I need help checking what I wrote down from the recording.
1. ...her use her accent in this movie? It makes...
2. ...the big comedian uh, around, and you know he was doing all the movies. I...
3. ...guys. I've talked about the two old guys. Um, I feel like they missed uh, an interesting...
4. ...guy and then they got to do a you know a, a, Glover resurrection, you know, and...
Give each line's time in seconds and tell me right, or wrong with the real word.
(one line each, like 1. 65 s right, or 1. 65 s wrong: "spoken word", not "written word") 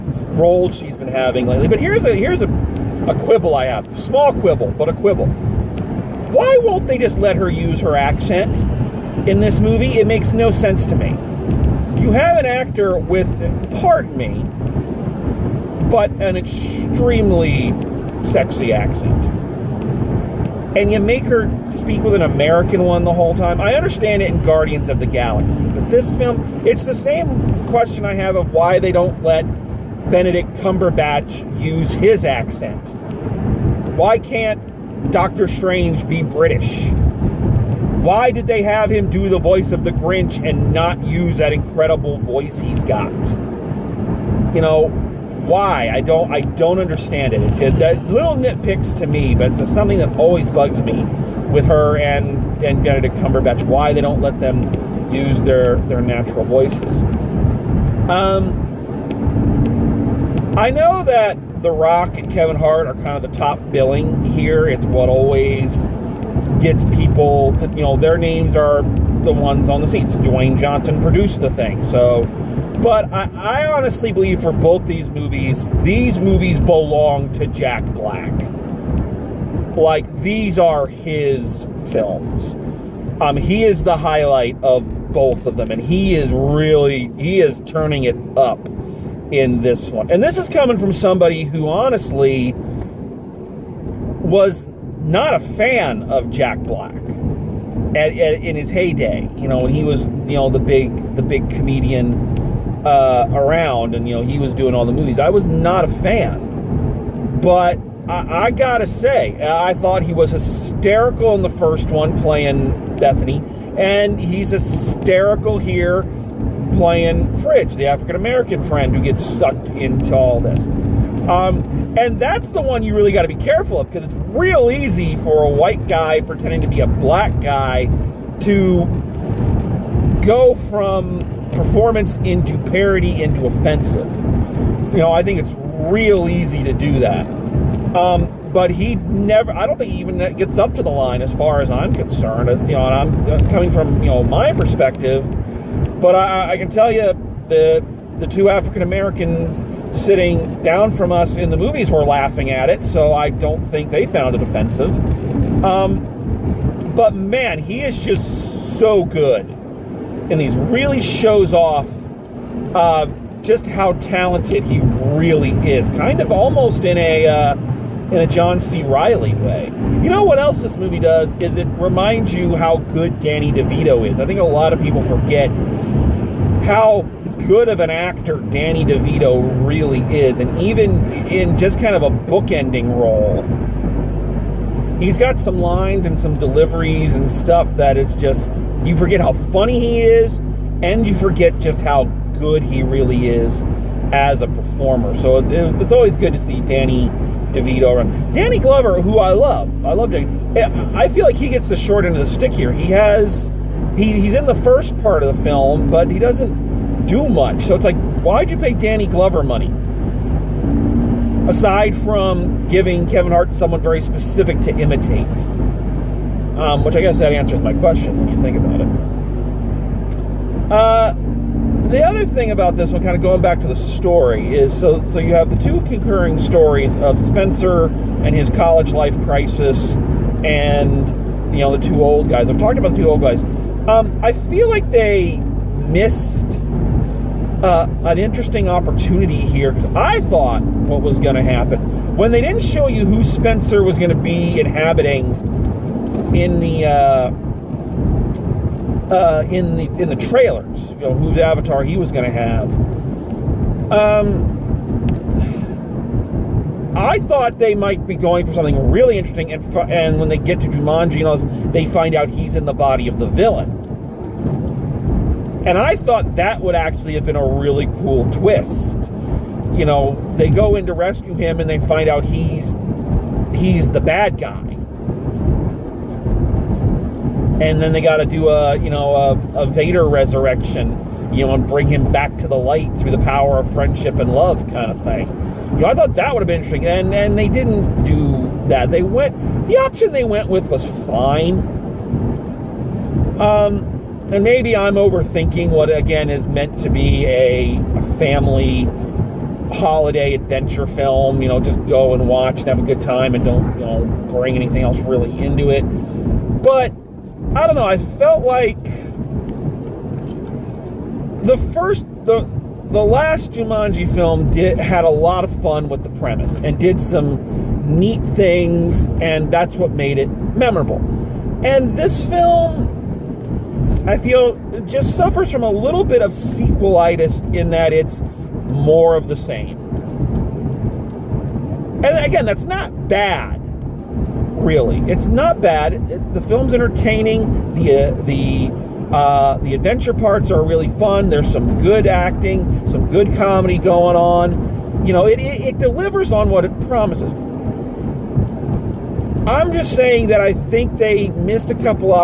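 1. 7 s right
2. 101 s right
3. 232 s right
4. 274 s wrong: "Vader", not "Glover".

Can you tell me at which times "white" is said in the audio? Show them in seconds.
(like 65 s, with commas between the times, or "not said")
125 s.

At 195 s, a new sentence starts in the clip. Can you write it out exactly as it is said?
So it's, always good to see Danny DeVito Run, Danny Glover, who I love, I love Danny.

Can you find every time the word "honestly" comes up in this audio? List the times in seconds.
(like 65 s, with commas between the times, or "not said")
73 s, 91 s.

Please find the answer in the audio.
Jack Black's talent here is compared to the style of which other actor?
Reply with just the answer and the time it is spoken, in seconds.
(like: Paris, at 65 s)
John C. Reilly, at 168 s.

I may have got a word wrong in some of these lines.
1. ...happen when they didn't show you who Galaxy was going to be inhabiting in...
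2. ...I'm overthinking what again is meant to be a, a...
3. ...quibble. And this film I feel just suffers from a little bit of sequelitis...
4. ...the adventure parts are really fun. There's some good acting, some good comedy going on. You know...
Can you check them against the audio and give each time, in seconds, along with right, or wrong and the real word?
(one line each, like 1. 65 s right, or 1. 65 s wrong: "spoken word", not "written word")
1. 241 s wrong: "Spencer", not "Galaxy"
2. 294 s right
3. 320 s wrong: "memorable", not "quibble"
4. 339 s right.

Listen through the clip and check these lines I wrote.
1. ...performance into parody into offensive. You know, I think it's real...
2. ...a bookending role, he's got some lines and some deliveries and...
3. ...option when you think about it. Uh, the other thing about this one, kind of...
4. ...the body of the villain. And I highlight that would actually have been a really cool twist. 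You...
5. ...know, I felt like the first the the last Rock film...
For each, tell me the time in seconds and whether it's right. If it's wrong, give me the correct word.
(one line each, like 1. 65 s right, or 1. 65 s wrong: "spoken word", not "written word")
1. 131 s right
2. 182 s right
3. 217 s wrong: "question", not "option"
4. 262 s wrong: "thought", not "highlight"
5. 307 s wrong: "Jumanji", not "Rock".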